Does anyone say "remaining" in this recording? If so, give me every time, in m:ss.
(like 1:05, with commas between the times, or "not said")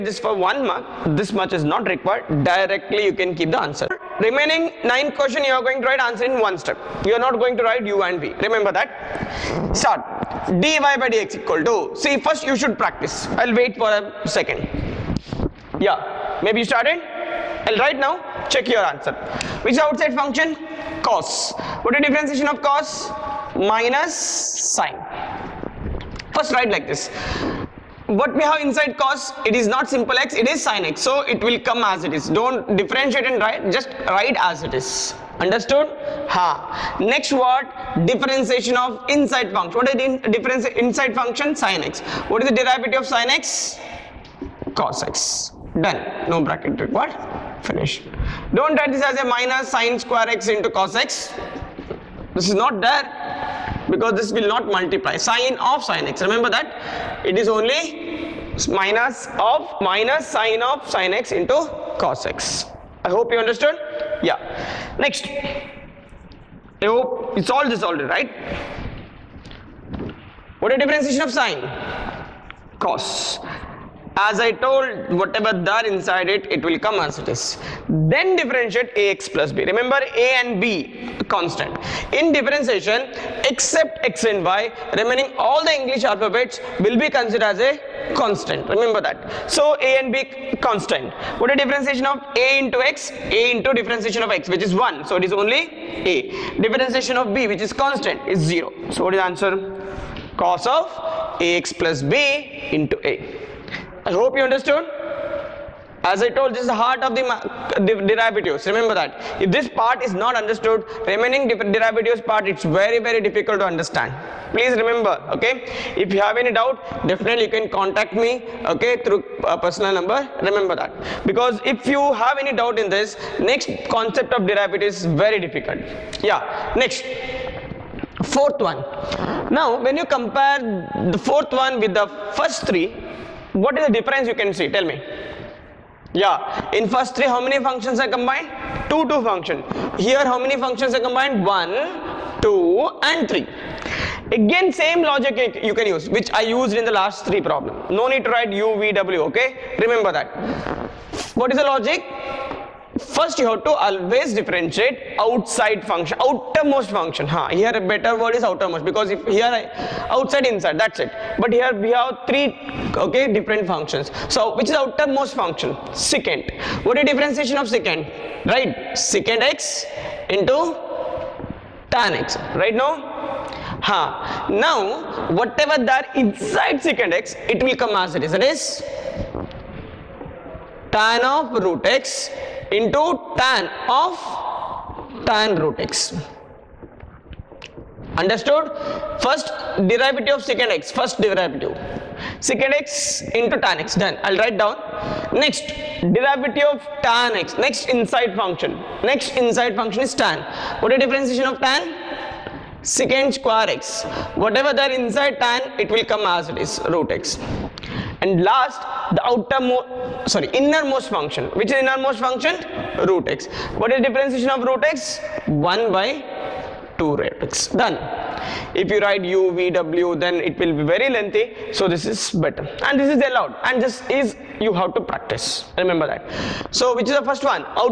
0:04, 1:24, 1:51.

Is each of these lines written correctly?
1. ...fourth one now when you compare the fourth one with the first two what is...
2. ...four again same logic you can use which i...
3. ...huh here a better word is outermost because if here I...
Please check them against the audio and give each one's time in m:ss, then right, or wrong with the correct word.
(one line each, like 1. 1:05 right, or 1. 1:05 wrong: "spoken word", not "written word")
1. 2:08 wrong: "three", not "two"
2. 2:23 wrong: "three", not "four"
3. 2:37 right.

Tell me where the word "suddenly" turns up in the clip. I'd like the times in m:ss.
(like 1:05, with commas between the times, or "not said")
not said.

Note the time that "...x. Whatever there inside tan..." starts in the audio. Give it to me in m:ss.
3:23.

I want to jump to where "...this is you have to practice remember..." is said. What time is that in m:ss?
3:43.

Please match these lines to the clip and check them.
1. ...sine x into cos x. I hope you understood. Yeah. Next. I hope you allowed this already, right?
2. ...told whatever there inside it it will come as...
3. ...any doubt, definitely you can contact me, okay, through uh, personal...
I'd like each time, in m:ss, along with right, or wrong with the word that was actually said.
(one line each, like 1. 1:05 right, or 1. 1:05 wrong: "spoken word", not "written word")
1. 1:00 wrong: "solved", not "allowed"
2. 1:14 right
3. 1:56 right.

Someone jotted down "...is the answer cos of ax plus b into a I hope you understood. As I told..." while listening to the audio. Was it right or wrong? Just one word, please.
right.